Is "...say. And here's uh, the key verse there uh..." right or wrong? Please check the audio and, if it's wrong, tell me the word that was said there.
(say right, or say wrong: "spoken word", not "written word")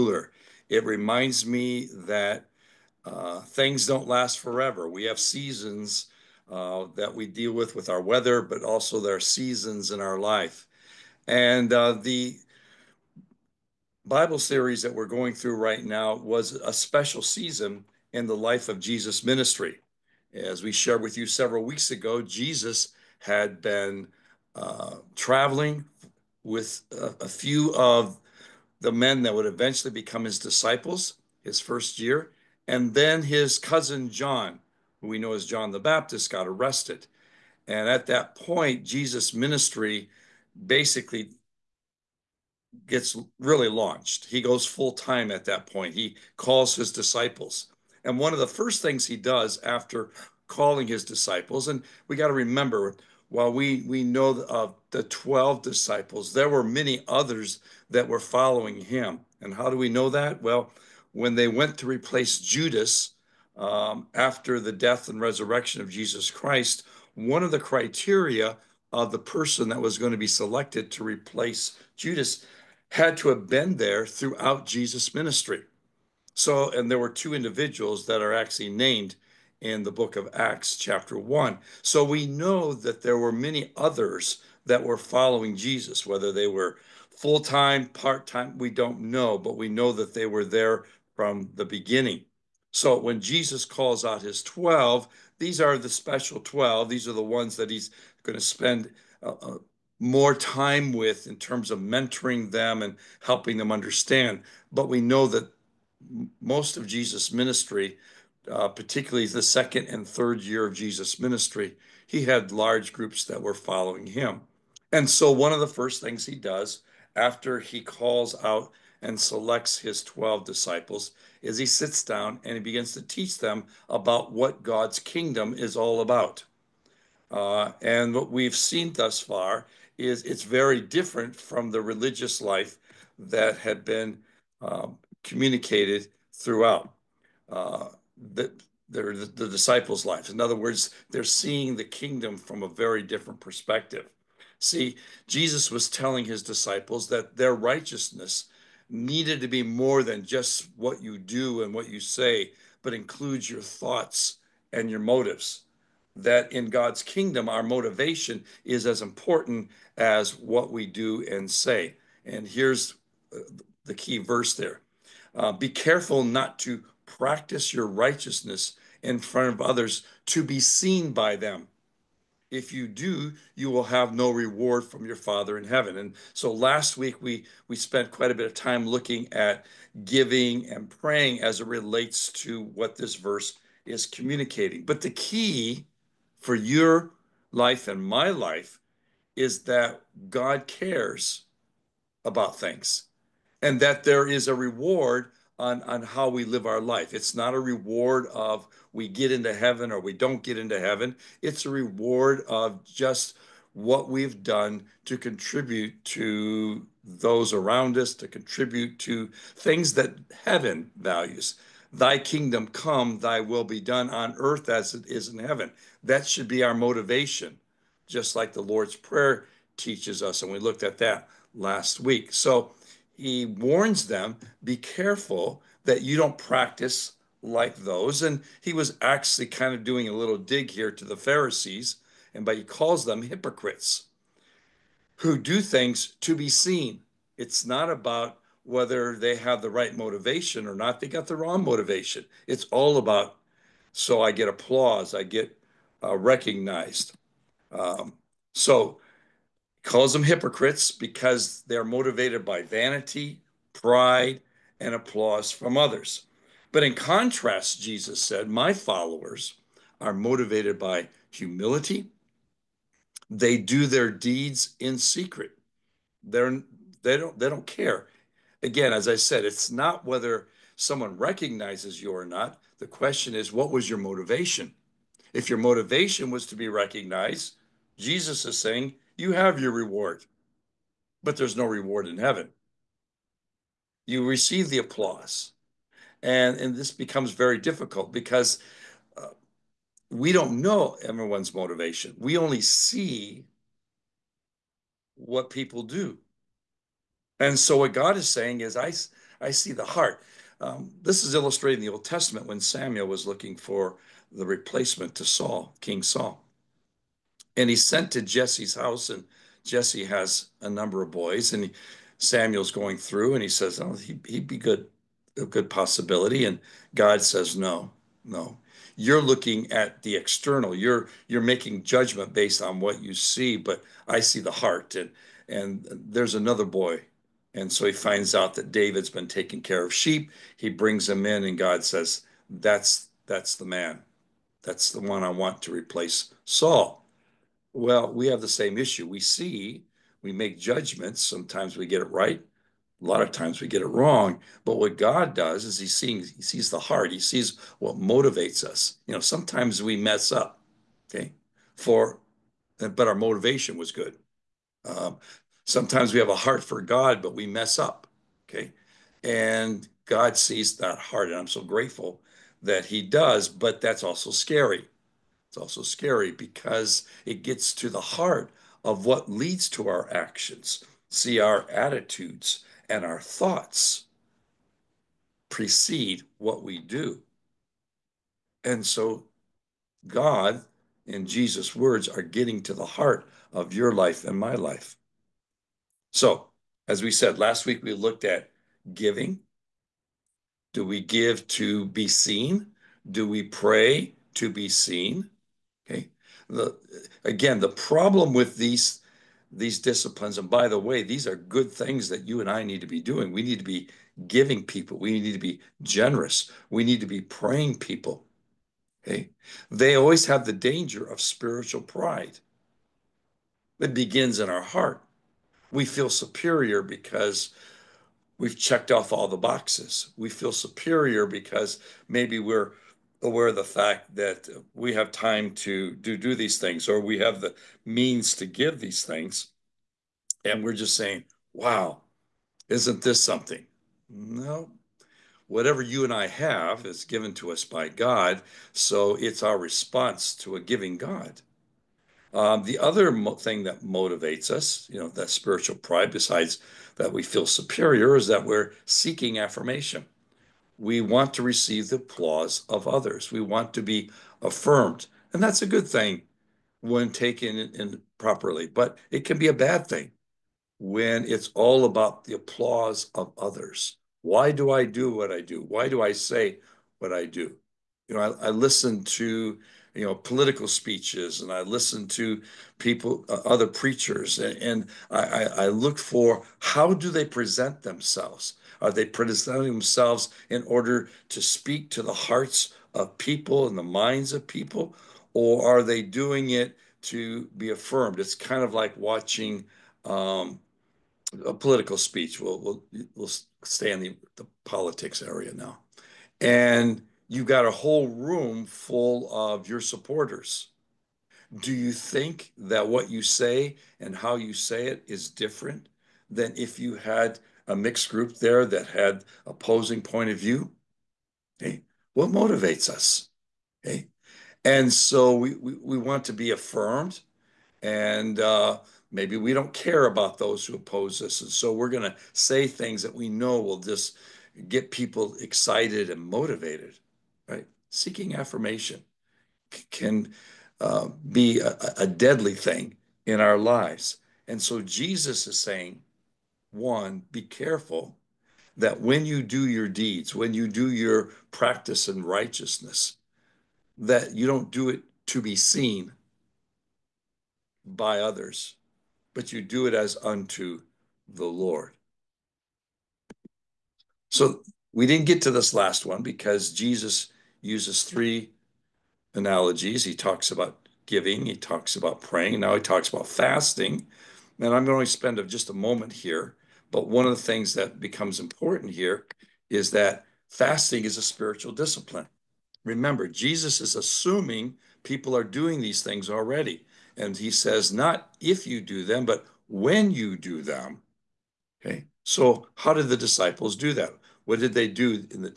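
right.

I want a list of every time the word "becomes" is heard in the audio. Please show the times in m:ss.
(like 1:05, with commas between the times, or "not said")
0:29, 4:46, 9:27.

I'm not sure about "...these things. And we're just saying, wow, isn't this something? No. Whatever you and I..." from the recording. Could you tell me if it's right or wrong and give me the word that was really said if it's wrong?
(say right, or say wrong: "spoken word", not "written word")
right.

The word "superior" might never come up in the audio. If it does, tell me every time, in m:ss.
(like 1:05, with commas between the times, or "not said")
6:56, 7:00, 7:27.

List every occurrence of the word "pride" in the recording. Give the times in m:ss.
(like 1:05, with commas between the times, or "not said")
4:13, 6:51, 7:25.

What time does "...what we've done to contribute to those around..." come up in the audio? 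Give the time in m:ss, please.
3:23.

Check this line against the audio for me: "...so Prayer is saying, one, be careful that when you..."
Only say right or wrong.
wrong.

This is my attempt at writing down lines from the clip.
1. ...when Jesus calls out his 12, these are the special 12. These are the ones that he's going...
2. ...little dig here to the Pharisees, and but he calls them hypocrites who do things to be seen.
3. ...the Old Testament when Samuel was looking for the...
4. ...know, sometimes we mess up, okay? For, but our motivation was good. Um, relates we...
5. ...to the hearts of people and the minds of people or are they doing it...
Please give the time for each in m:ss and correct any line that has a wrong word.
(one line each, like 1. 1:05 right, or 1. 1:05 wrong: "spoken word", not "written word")
1. 1:32 right
2. 3:50 right
3. 5:01 right
4. 5:49 wrong: "sometimes", not "relates"
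5. 8:01 right.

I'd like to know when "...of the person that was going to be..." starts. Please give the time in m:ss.
1:08.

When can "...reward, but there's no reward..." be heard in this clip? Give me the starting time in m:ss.
4:39.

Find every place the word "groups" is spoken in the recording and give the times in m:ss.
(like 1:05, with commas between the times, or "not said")
1:52, 8:28.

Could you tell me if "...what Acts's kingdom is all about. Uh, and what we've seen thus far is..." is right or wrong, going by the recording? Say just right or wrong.
wrong.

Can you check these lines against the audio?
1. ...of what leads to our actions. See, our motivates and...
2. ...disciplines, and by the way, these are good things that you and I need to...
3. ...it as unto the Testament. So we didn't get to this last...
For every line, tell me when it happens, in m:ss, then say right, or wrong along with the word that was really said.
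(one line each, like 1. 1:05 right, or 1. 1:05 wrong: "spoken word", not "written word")
1. 6:08 wrong: "attitudes", not "motivates"
2. 6:39 right
3. 9:09 wrong: "Lord", not "Testament".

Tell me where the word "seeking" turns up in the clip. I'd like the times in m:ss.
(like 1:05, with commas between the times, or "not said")
7:28, 8:47.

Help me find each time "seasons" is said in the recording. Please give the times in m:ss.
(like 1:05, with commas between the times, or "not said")
0:05, 0:09, 0:17.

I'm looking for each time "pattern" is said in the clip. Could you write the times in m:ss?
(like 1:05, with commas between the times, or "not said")
not said.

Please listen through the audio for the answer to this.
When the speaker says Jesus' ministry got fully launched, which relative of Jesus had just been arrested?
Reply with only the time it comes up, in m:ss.
0:33.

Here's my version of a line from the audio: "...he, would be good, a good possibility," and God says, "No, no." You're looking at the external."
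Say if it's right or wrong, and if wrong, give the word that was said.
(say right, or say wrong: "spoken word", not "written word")
right.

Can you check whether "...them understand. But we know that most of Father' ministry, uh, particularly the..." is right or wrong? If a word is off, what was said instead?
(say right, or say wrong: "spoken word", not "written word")
wrong: "Jesus", not "Father".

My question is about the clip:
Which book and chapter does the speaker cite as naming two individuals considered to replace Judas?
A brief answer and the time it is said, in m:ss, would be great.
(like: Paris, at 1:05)
Acts, chapter 1, at 1:19.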